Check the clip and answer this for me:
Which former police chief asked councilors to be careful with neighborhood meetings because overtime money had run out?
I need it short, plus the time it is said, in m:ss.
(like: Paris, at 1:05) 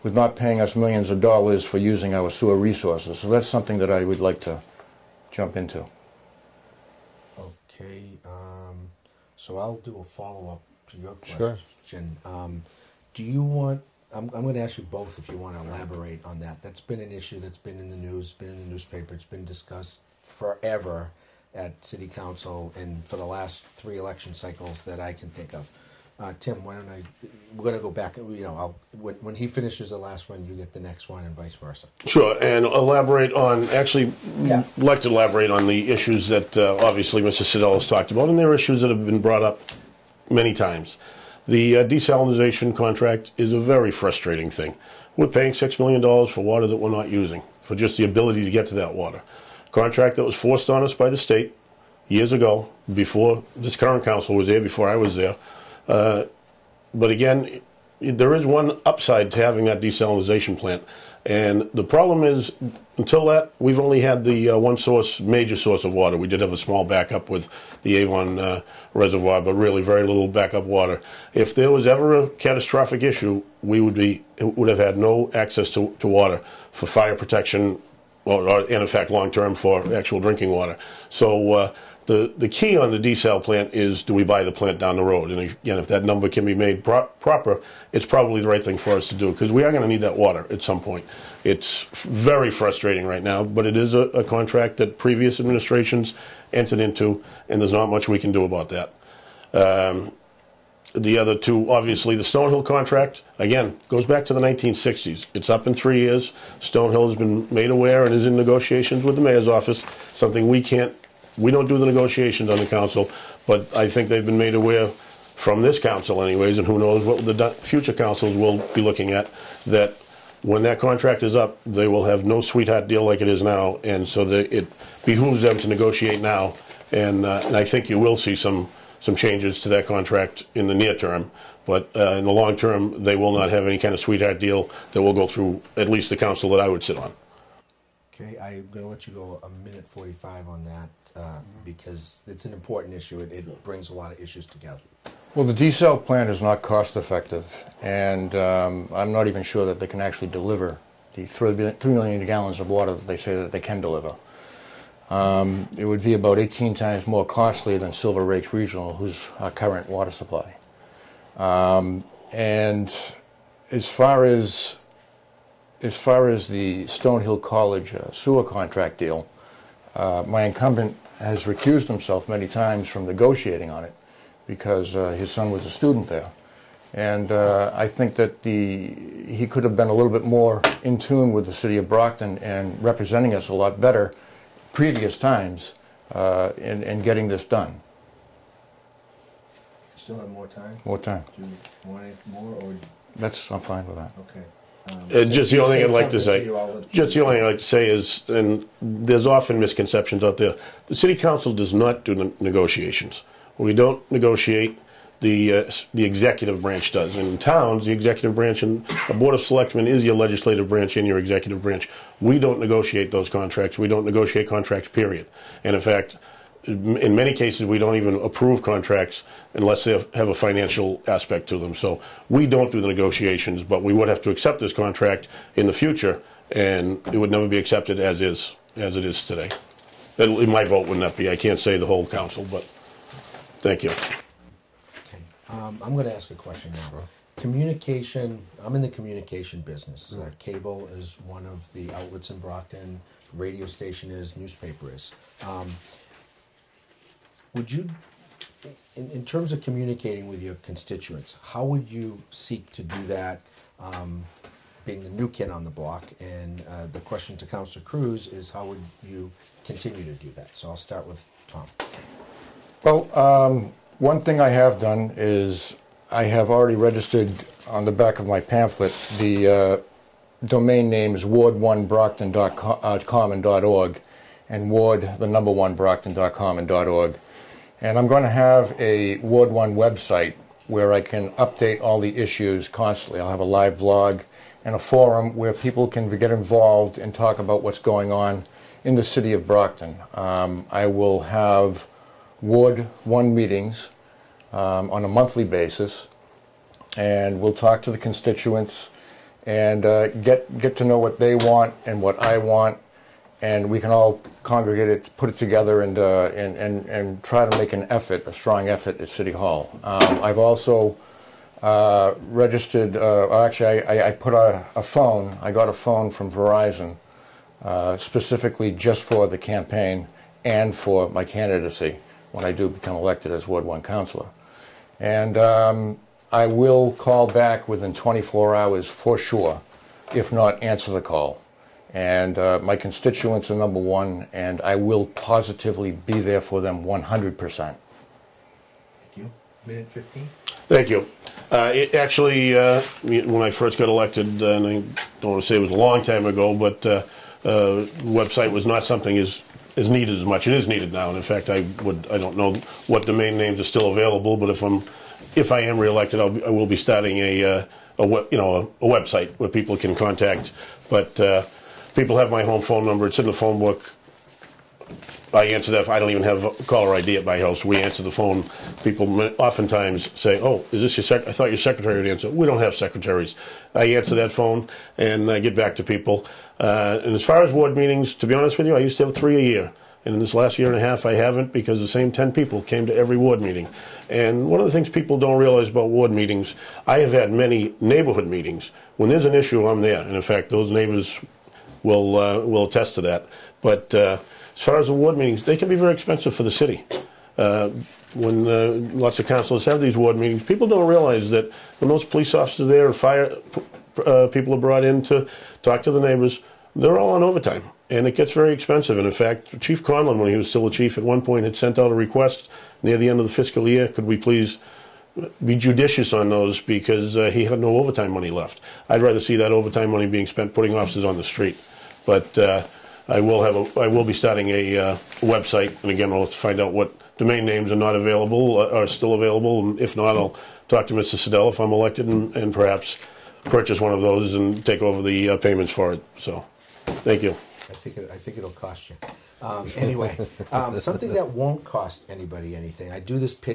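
Chief Conlon, at 6:49.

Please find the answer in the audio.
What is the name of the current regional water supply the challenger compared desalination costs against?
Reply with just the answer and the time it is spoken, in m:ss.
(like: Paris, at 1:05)
Silver Lake Regional, at 2:37.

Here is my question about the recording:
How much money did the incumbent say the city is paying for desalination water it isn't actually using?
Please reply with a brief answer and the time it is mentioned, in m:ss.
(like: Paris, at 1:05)
$6 million, at 0:45.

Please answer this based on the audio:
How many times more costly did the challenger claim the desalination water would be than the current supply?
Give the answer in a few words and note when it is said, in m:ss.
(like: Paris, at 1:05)
18, at 2:36.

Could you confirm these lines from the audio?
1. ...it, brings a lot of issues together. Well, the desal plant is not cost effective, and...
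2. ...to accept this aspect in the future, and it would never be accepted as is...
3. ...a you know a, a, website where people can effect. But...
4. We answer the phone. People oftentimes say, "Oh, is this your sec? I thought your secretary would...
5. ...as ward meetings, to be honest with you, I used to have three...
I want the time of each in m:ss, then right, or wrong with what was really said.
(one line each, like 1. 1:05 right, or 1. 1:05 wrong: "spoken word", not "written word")
1. 2:23 right
2. 3:44 wrong: "contract", not "aspect"
3. 5:57 wrong: "contact", not "effect"
4. 6:07 right
5. 6:17 right.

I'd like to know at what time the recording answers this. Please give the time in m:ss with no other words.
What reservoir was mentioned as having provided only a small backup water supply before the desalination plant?
1:07.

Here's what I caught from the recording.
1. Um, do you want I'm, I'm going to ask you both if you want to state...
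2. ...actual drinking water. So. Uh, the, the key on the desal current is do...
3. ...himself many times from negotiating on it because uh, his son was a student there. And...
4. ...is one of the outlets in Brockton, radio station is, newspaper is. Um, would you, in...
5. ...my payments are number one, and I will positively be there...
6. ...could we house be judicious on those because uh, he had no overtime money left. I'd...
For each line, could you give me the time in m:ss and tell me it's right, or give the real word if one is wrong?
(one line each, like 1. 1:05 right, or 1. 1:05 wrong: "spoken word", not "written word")
1. 0:12 wrong: "elaborate", not "state"
2. 1:19 wrong: "plant", not "current"
3. 2:51 right
4. 4:00 right
5. 5:32 wrong: "constituents", not "payments"
6. 6:53 wrong: "please", not "house".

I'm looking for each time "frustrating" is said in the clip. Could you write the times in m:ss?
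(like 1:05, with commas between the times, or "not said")
0:43, 1:32.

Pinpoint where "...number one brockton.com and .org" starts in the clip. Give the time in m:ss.
4:35.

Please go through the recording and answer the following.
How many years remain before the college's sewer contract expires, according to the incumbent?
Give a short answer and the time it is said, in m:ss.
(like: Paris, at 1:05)
3, at 1:45.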